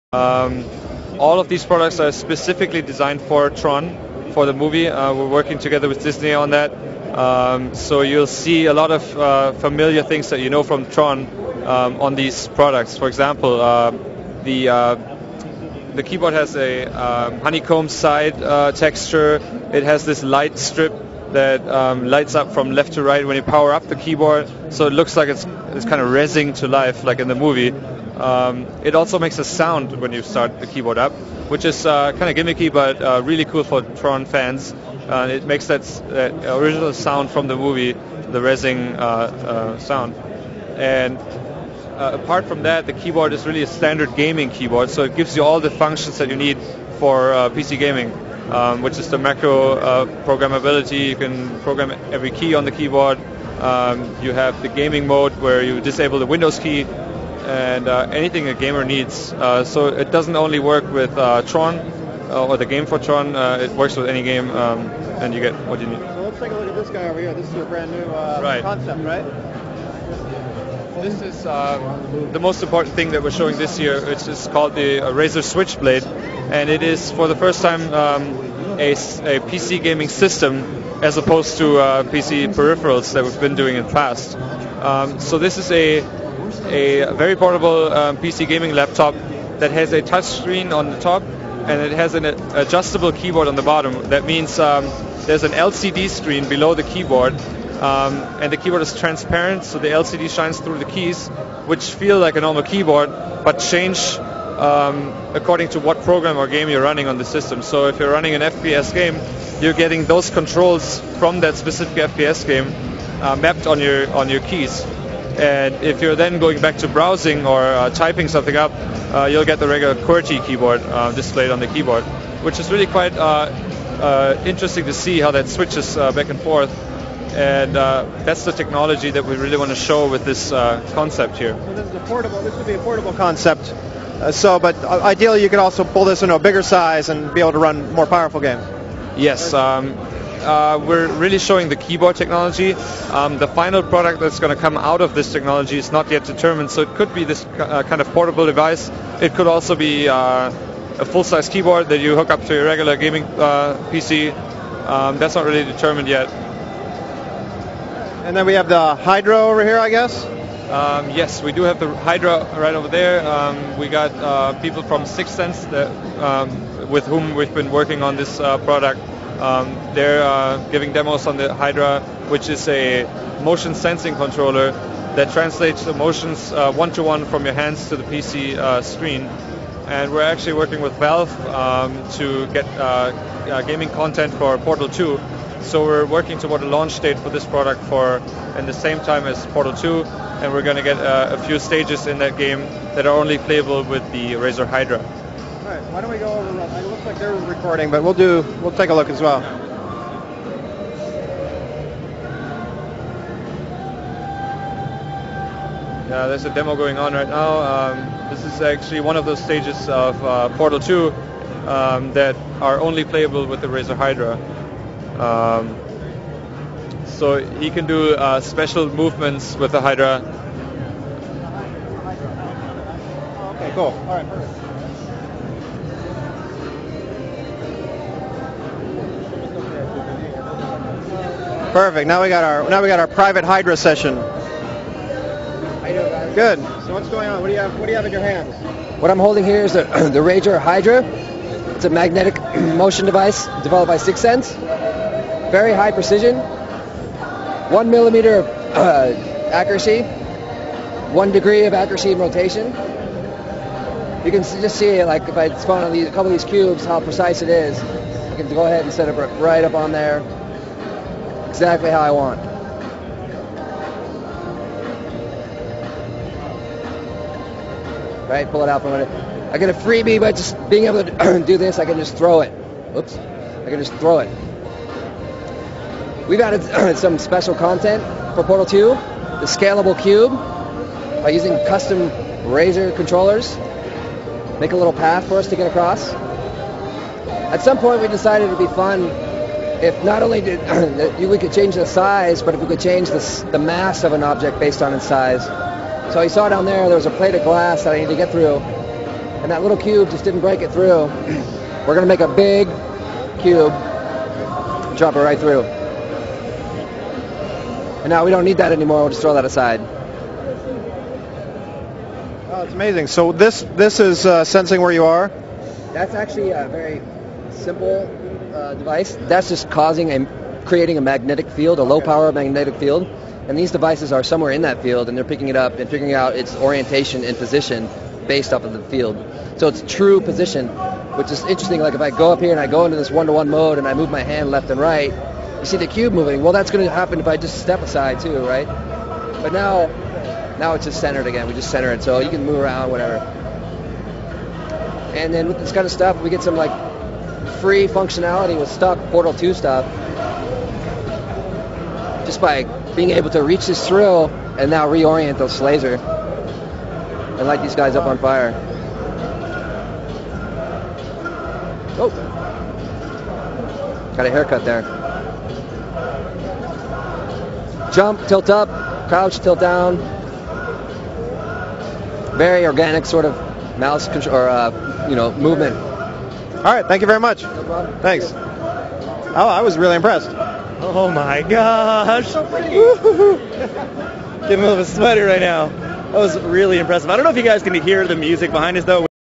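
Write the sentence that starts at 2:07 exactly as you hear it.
And that's the technology that we really want to show with this concept here.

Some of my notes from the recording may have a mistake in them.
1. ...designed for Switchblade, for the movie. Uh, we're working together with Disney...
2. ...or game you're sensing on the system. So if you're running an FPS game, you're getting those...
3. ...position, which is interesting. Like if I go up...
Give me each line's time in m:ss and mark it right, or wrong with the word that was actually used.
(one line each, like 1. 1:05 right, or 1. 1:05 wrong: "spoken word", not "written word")
1. 0:02 wrong: "Tron", not "Switchblade"
2. 1:46 wrong: "running", not "sensing"
3. 5:30 right.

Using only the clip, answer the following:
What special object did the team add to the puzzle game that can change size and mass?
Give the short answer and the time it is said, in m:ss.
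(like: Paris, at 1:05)
Scalable cube, at 4:38.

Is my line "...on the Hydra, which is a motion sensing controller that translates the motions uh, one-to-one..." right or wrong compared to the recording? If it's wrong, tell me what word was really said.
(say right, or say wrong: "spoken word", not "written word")
right.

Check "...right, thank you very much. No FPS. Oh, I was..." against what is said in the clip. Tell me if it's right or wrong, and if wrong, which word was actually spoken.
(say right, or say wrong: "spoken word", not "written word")
wrong: "Thanks", not "FPS".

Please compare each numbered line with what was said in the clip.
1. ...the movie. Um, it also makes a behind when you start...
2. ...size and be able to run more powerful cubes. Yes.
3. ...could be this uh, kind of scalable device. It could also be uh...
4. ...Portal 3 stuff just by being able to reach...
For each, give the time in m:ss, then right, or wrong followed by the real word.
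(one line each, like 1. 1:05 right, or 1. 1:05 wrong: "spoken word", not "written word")
1. 0:27 wrong: "sound", not "behind"
2. 2:16 wrong: "games", not "cubes"
3. 2:26 wrong: "portable", not "scalable"
4. 5:49 wrong: "2", not "3".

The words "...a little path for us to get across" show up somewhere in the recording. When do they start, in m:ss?
4:44.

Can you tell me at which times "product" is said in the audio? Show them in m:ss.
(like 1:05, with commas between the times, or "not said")
0:01, 0:12, 2:23, 2:48, 3:07.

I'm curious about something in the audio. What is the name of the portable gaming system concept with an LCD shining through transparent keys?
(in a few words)
Razer Switchblade.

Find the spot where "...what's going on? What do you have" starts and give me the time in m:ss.
3:56.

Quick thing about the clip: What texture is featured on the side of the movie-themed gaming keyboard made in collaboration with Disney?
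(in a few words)
Honeycomb.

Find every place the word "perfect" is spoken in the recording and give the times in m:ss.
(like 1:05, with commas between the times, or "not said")
3:44, 3:51.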